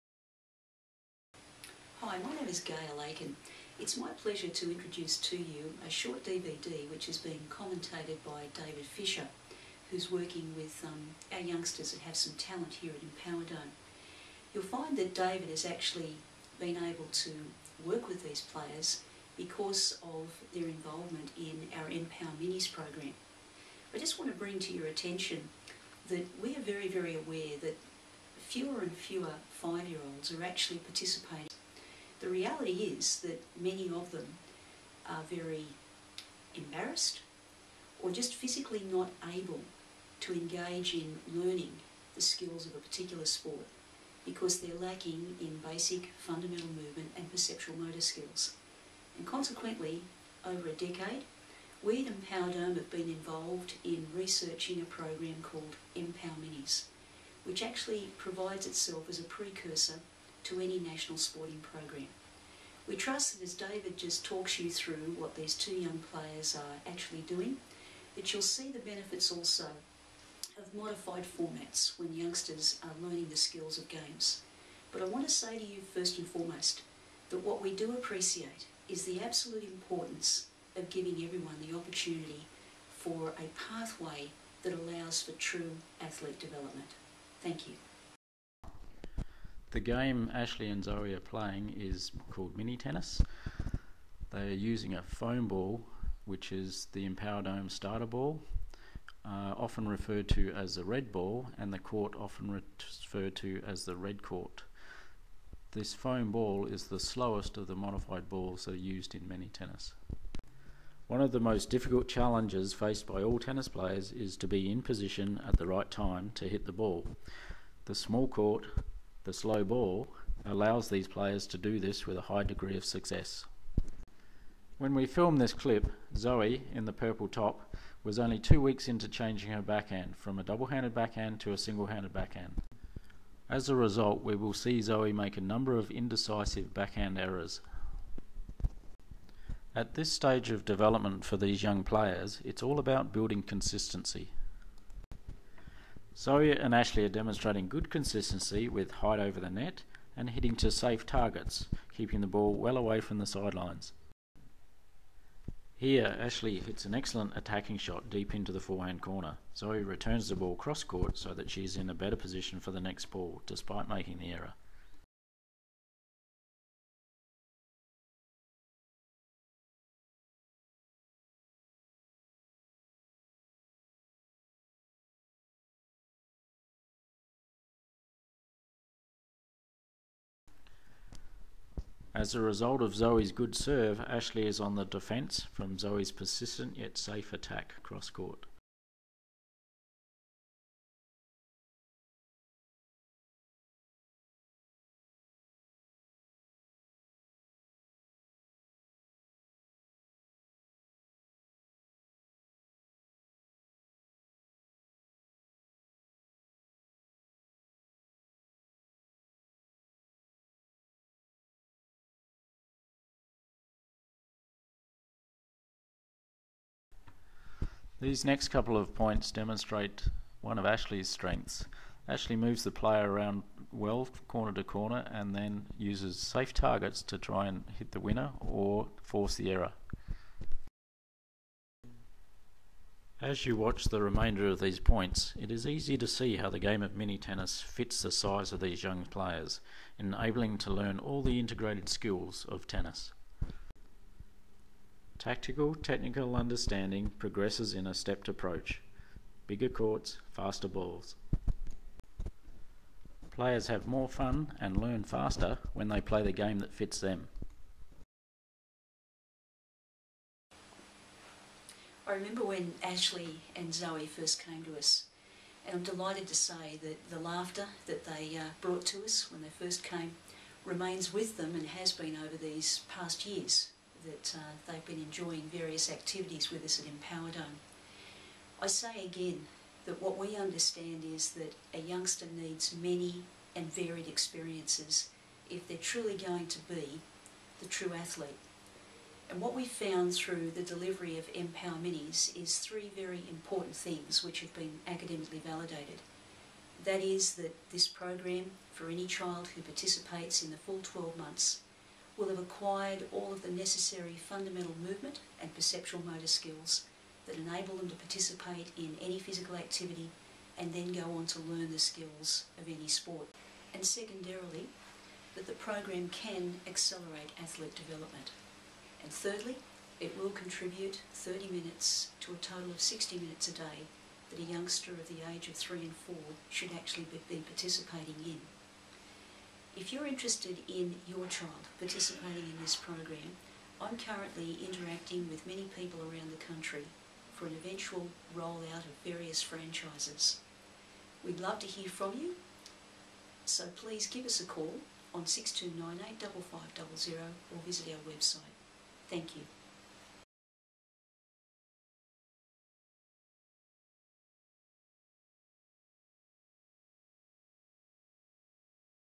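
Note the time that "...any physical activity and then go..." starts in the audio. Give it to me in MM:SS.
05:09.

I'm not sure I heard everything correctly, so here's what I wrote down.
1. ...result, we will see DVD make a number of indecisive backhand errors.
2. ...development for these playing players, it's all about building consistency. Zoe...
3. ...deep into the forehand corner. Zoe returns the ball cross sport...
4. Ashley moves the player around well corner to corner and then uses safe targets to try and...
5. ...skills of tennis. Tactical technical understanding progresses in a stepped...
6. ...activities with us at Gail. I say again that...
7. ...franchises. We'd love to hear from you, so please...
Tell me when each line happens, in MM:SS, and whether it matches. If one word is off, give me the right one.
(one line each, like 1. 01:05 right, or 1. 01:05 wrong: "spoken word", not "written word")
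1. 02:13 wrong: "Zoe", not "DVD"
2. 02:20 wrong: "young", not "playing"
3. 02:38 wrong: "court", not "sport"
4. 03:42 right
5. 04:01 right
6. 04:35 wrong: "Dome", not "Gail"
7. 05:39 right.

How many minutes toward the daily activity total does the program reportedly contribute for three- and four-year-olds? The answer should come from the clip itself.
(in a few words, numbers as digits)
30.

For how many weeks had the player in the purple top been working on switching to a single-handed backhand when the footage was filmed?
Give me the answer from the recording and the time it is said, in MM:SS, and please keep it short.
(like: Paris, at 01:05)
2, at 02:08.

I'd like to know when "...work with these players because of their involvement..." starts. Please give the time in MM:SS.
00:17.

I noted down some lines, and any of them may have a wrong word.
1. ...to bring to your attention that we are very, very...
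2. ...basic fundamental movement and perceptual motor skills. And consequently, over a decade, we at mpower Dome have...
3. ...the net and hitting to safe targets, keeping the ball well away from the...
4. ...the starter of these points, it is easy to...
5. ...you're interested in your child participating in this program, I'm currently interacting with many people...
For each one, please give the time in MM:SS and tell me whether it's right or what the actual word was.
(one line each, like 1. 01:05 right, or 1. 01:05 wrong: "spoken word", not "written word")
1. 00:24 right
2. 00:45 right
3. 02:29 right
4. 03:53 wrong: "remainder", not "starter"
5. 05:29 right.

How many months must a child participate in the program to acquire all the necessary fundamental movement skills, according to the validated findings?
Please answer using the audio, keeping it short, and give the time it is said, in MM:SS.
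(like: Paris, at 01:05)
12, at 05:00.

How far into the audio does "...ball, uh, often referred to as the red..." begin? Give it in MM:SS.
01:38.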